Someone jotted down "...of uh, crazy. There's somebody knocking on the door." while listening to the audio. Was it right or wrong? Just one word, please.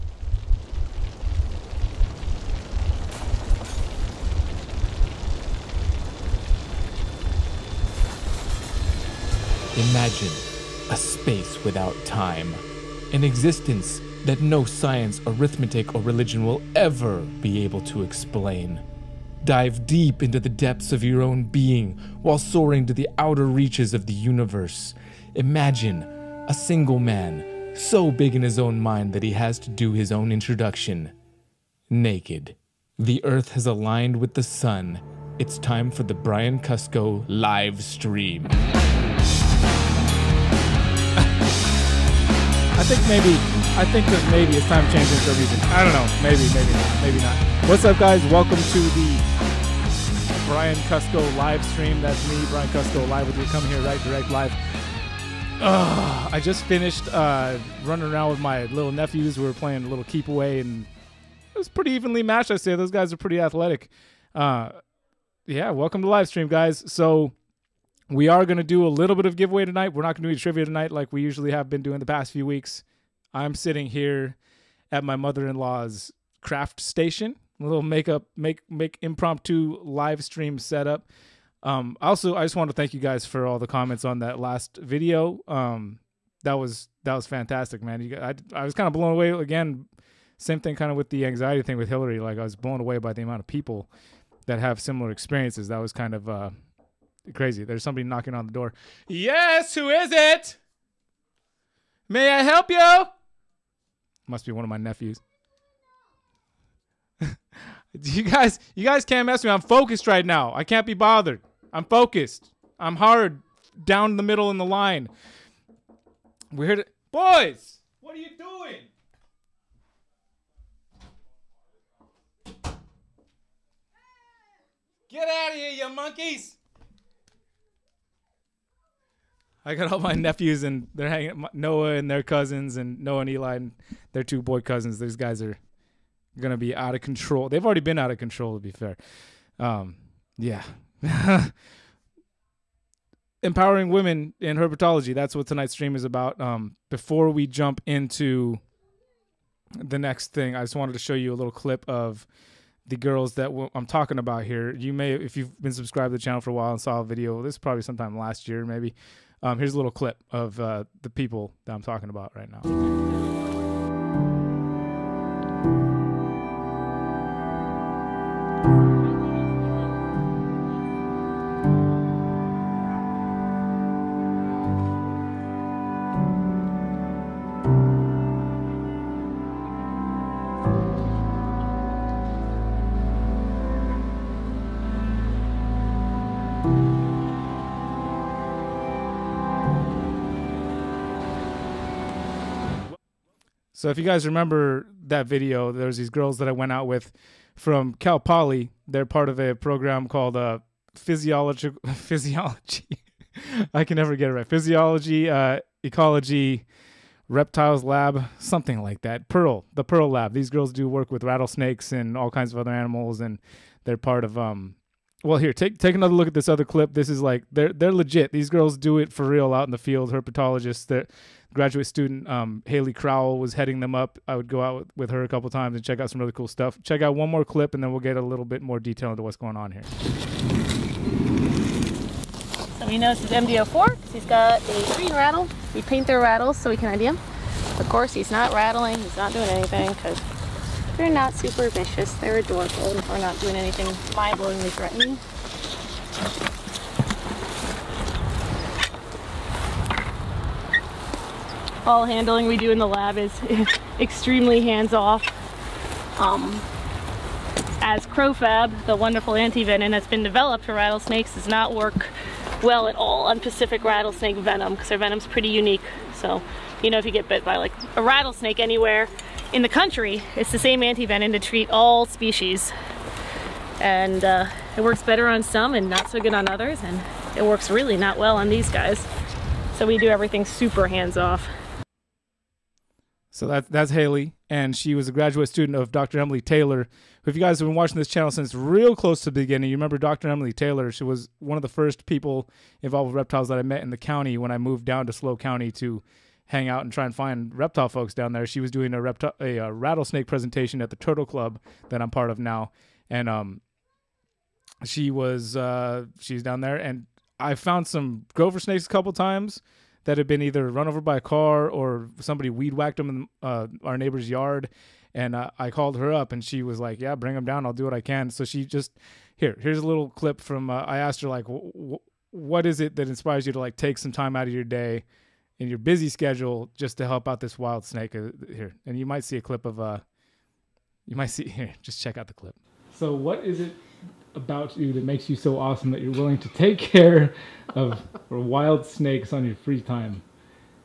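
right.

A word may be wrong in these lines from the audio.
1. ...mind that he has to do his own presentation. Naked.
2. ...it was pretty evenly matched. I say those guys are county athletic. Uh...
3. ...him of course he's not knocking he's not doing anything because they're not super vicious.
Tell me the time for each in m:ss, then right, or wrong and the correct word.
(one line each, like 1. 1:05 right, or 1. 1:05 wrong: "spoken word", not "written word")
1. 0:28 wrong: "introduction", not "presentation"
2. 1:01 wrong: "pretty", not "county"
3. 3:57 wrong: "rattling", not "knocking".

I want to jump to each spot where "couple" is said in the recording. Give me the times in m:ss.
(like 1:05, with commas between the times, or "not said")
3:45, 5:08.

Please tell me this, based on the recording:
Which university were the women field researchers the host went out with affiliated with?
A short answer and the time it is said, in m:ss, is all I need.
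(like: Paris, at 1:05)
Cal Poly, at 3:17.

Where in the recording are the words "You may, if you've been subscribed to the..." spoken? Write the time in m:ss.
2:34.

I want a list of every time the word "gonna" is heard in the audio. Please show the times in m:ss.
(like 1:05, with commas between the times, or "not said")
2:16.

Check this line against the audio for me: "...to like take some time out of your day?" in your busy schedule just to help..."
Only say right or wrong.
right.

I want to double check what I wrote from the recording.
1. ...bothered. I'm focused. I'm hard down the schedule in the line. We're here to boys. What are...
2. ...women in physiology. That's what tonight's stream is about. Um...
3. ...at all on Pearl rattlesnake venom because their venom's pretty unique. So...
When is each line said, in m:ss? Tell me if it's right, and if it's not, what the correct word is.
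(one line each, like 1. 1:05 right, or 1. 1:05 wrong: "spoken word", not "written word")
1. 1:50 wrong: "middle", not "schedule"
2. 2:23 wrong: "herpetology", not "physiology"
3. 4:22 wrong: "Pacific", not "Pearl".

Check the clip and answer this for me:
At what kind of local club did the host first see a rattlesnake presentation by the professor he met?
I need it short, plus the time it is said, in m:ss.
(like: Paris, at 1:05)
Turtle Club, at 5:00.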